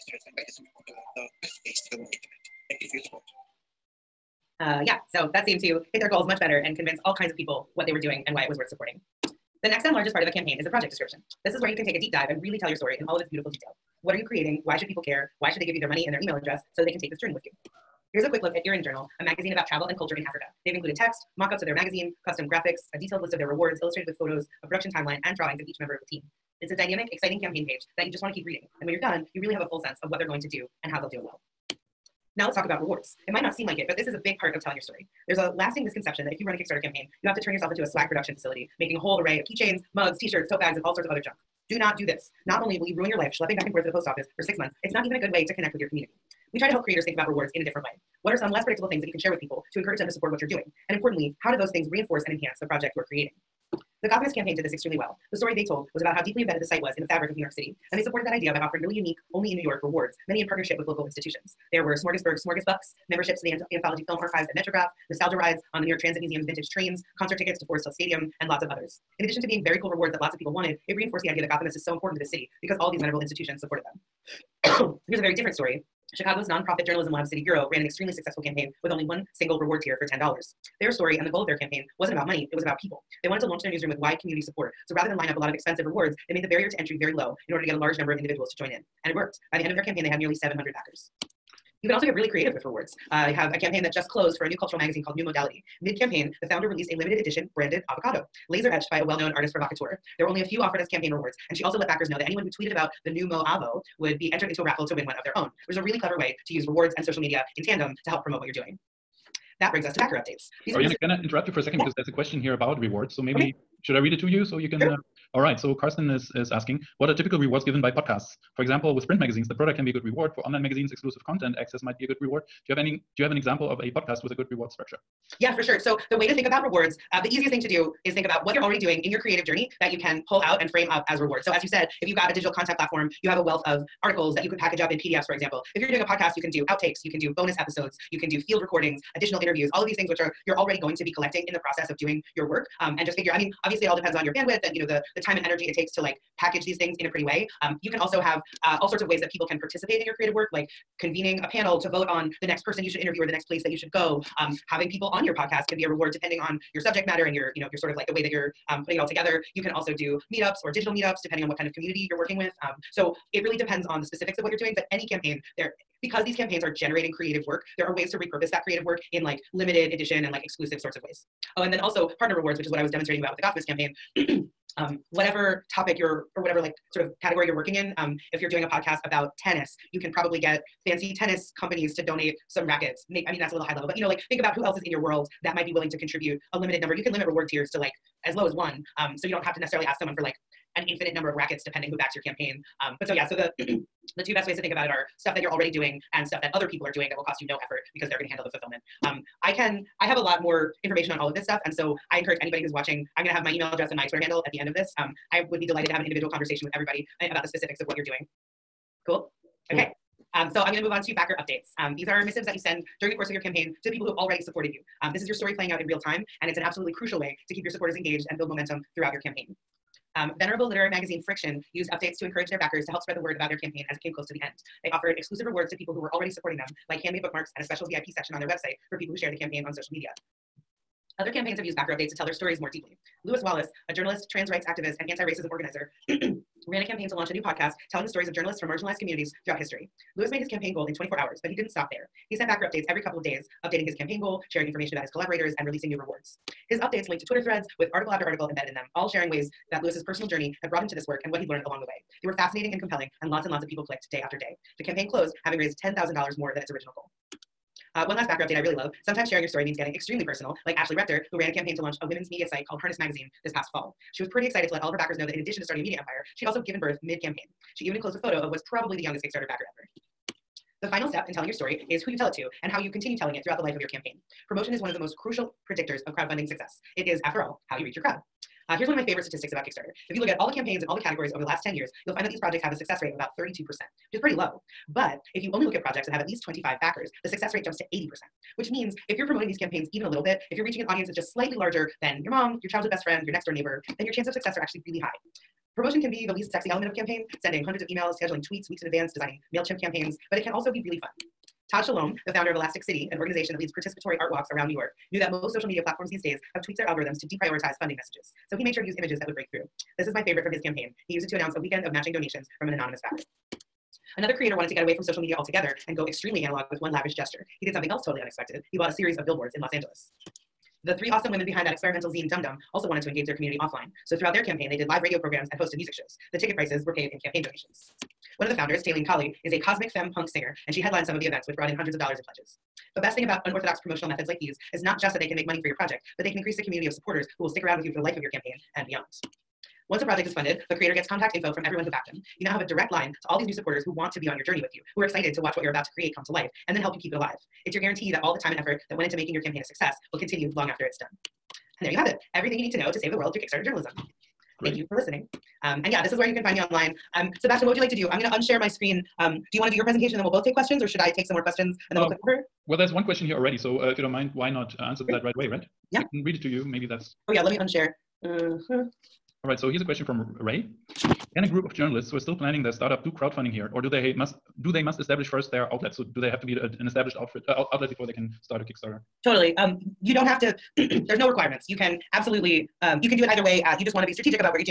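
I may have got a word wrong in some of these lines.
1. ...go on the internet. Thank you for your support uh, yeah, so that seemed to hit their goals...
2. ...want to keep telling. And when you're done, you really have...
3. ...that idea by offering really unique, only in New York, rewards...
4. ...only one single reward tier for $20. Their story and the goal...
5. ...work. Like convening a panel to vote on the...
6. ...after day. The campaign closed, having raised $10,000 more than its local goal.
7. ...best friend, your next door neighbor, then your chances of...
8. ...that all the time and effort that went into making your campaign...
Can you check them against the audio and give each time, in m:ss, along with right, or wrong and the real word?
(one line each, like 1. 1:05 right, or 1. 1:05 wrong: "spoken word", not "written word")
1. 0:01 right
2. 0:28 wrong: "reading", not "telling"
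3. 0:58 right
4. 1:18 wrong: "10", not "20"
5. 2:30 right
6. 4:14 wrong: "original", not "local"
7. 4:52 right
8. 5:48 right.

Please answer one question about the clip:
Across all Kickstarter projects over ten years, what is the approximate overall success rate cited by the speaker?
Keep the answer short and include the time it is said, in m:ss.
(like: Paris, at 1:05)
32%, at 4:43.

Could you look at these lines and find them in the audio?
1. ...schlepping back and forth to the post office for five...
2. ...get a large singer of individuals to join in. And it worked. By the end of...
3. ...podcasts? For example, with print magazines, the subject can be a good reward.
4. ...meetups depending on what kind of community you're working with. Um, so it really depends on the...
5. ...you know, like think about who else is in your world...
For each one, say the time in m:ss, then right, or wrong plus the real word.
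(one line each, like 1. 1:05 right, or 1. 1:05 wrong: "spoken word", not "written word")
1. 0:43 wrong: "six", not "five"
2. 1:27 wrong: "number", not "singer"
3. 1:57 wrong: "product", not "subject"
4. 2:40 right
5. 3:03 right.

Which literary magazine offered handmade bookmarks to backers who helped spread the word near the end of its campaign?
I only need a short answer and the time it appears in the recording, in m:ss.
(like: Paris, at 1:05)
Friction, at 3:41.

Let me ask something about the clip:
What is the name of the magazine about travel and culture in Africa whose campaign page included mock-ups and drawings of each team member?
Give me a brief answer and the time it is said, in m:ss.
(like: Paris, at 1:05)
Erin Journal, at 0:18.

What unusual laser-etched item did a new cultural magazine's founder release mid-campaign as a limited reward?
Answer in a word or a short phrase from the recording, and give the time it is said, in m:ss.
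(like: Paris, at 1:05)
branded avocado, at 1:37.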